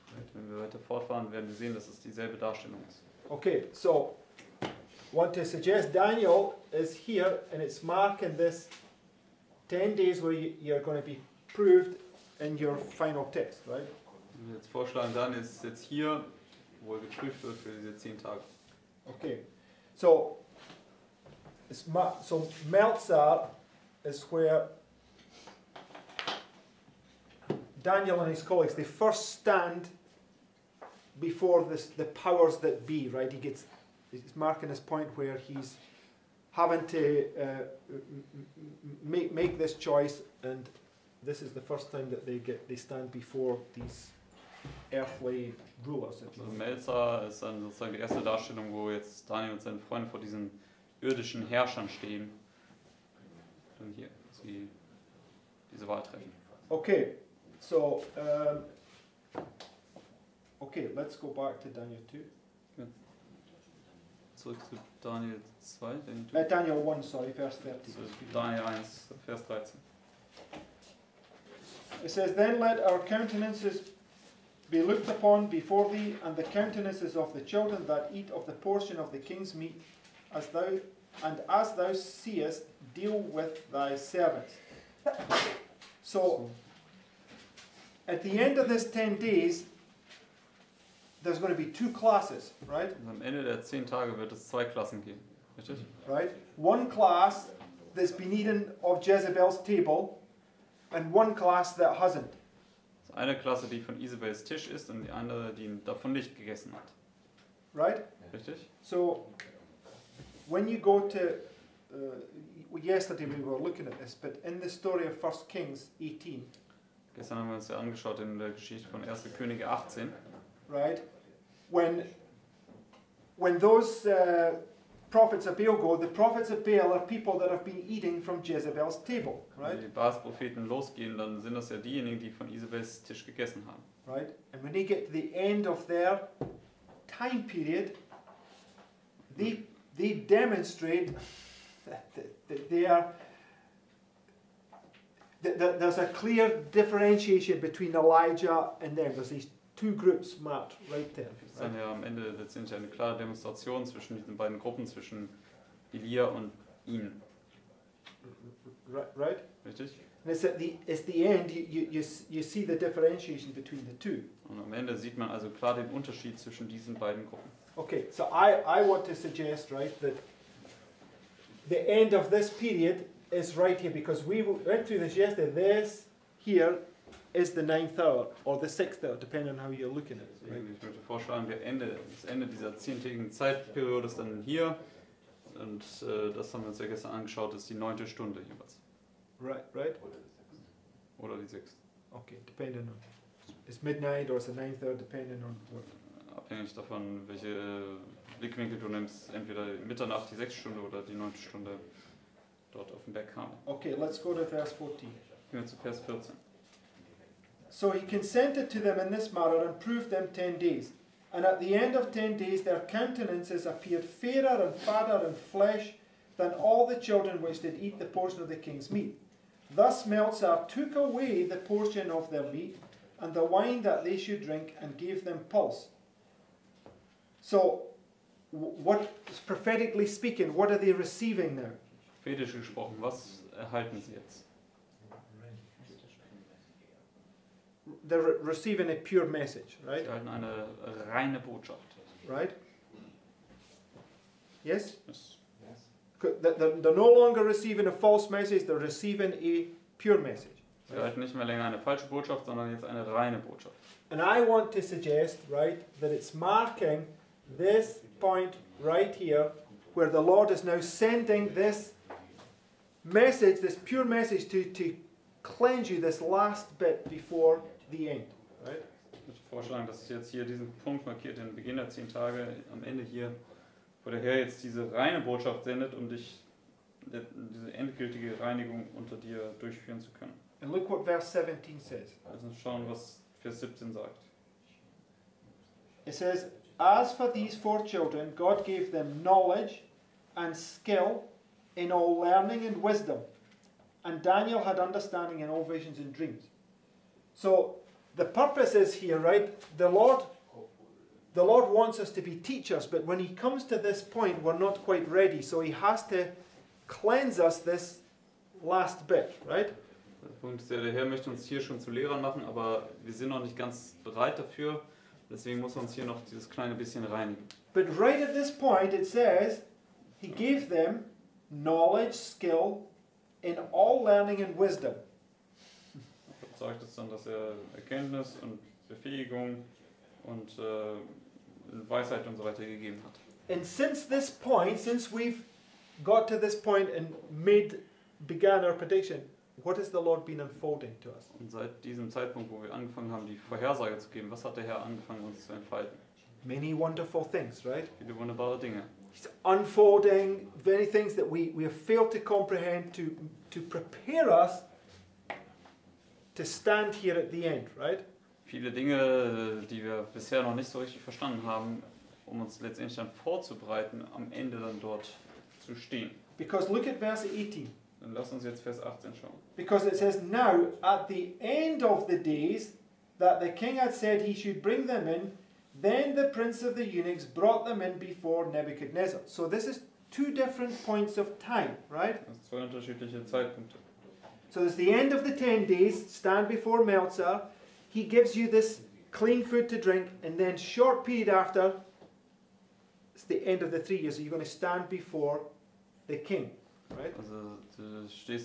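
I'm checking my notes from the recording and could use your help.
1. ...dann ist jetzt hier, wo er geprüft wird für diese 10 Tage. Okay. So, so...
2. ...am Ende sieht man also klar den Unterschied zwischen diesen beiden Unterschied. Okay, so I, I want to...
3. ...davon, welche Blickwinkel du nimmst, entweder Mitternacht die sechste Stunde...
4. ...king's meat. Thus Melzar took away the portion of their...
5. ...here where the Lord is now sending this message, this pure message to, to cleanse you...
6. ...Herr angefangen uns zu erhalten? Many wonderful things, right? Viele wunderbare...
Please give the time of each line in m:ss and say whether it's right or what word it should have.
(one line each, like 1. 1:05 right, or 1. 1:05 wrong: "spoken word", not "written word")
1. 0:15 right
2. 2:44 wrong: "Gruppen", not "Unterschied"
3. 3:16 right
4. 3:38 right
5. 4:19 right
6. 5:44 wrong: "entfalten", not "erhalten".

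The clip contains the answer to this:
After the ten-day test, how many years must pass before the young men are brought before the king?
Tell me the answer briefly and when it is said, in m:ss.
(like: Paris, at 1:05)
3, at 6:33.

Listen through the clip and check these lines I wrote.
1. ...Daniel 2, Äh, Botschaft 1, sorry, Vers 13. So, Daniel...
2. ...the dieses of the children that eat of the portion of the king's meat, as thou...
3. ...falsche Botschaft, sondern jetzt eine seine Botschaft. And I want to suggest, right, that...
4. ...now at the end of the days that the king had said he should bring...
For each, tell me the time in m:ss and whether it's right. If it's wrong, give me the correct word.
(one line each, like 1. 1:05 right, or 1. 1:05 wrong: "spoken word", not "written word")
1. 1:05 wrong: "Daniel", not "Botschaft"
2. 1:16 wrong: "countenances", not "dieses"
3. 4:11 wrong: "reine", not "seine"
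4. 6:10 right.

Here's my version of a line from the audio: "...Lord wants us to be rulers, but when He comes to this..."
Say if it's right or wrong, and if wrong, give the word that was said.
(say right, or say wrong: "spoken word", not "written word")
wrong: "teachers", not "rulers".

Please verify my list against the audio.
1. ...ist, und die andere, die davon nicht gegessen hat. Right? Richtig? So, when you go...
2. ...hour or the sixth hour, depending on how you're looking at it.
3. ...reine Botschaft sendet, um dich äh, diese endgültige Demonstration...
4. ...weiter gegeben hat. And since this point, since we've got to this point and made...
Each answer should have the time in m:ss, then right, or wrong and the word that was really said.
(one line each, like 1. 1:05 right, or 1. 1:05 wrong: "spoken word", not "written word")
1. 1:44 right
2. 2:57 right
3. 4:34 wrong: "Reinigung", not "Demonstration"
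4. 5:32 right.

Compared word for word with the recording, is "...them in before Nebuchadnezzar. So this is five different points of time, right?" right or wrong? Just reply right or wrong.
wrong.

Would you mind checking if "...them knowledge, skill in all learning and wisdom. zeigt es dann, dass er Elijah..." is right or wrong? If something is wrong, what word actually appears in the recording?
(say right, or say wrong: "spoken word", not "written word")
wrong: "Erkenntnis", not "Elijah".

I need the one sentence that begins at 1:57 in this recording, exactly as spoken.
Gestern haben wir uns ja angeschaut in der Geschichte von 1.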